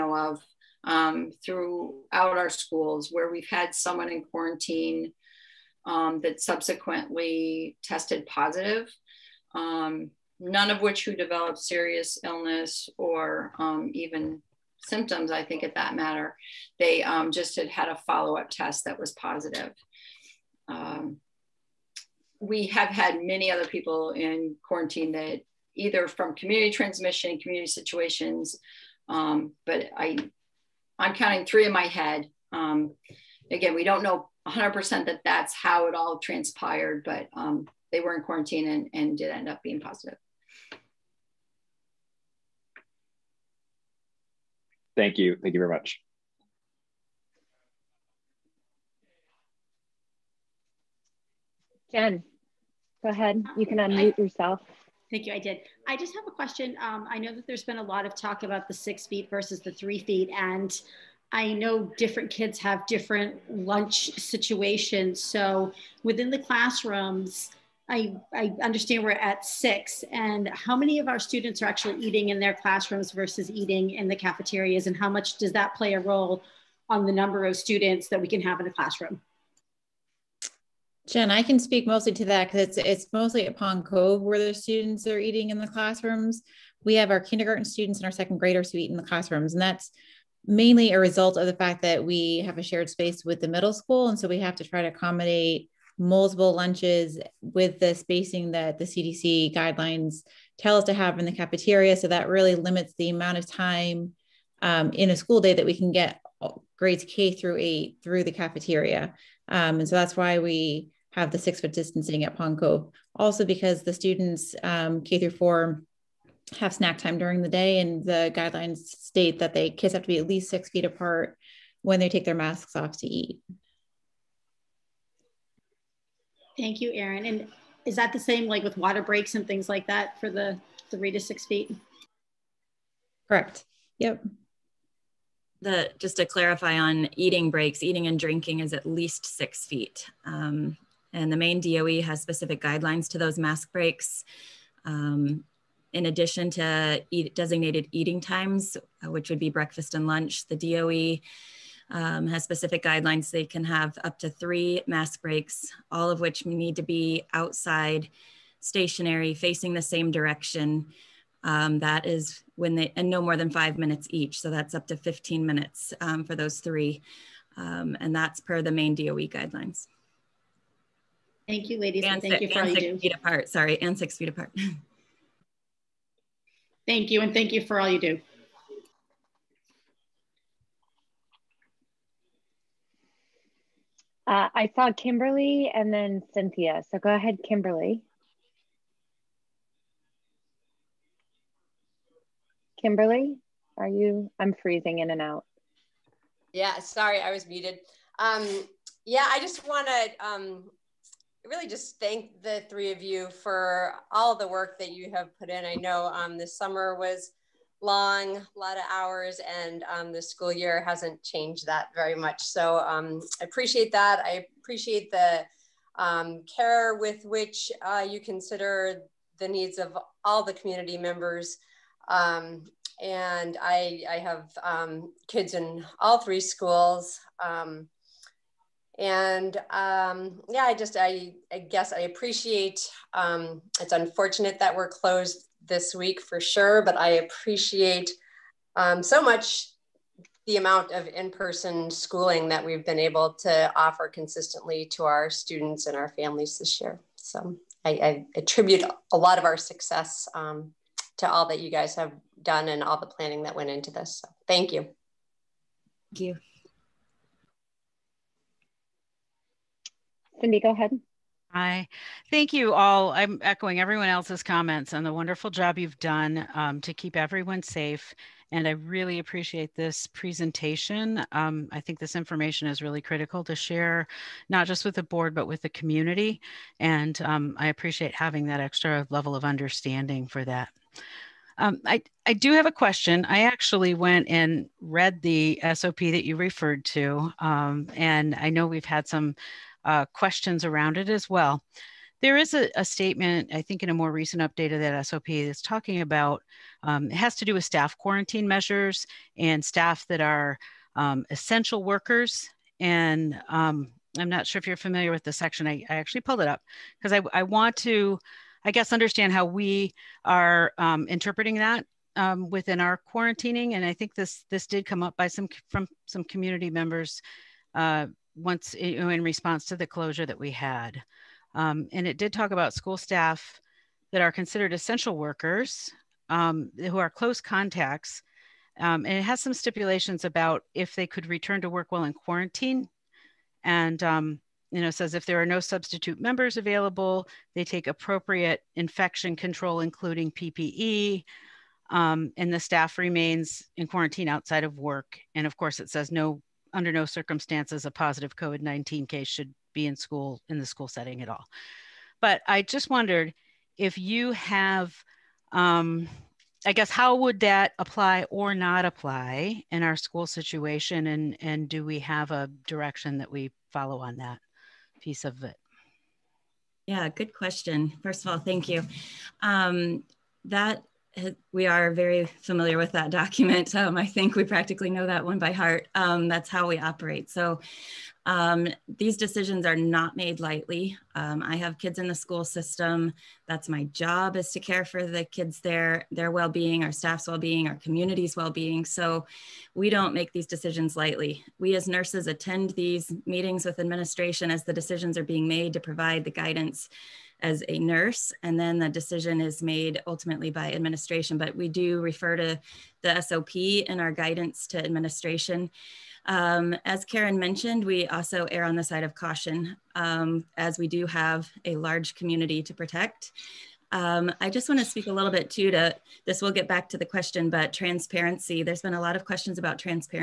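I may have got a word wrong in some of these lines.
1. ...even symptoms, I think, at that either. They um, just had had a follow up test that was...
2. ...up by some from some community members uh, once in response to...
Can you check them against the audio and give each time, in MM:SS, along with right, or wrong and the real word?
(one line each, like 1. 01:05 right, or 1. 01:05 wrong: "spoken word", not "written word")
1. 00:13 wrong: "matter", not "either"
2. 05:15 right.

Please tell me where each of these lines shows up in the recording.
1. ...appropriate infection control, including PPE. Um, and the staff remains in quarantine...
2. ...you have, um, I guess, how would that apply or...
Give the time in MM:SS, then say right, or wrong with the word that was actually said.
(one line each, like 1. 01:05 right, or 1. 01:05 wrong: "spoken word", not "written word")
1. 05:37 right
2. 05:53 right.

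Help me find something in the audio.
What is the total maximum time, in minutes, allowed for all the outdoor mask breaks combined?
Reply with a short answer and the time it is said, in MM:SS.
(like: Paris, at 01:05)
15 minutes, at 02:44.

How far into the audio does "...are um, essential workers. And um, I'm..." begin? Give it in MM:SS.
05:00.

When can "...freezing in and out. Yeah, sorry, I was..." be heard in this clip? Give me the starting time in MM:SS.
03:14.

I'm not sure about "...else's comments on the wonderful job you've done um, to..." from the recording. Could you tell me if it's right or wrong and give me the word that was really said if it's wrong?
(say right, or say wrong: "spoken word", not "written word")
right.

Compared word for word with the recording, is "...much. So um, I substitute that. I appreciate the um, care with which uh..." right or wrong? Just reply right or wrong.
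wrong.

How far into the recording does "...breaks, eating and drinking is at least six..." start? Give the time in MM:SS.
02:17.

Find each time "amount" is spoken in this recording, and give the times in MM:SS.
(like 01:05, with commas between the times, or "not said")
01:43, 04:00.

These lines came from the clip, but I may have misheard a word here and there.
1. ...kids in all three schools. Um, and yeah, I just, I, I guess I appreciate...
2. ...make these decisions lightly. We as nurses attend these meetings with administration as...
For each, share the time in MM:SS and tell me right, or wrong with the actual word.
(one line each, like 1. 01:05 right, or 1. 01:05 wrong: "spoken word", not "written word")
1. 03:45 right
2. 06:30 right.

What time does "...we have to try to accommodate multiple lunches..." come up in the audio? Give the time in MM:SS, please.
01:34.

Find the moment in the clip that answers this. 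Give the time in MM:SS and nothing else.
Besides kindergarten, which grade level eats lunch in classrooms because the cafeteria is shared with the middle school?
01:28.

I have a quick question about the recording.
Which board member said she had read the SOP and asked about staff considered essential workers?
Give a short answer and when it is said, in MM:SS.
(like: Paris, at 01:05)
Cindy, at 04:20.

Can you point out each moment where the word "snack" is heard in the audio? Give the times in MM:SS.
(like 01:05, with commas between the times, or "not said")
01:56.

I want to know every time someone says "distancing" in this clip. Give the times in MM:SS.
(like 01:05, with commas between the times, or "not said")
01:51.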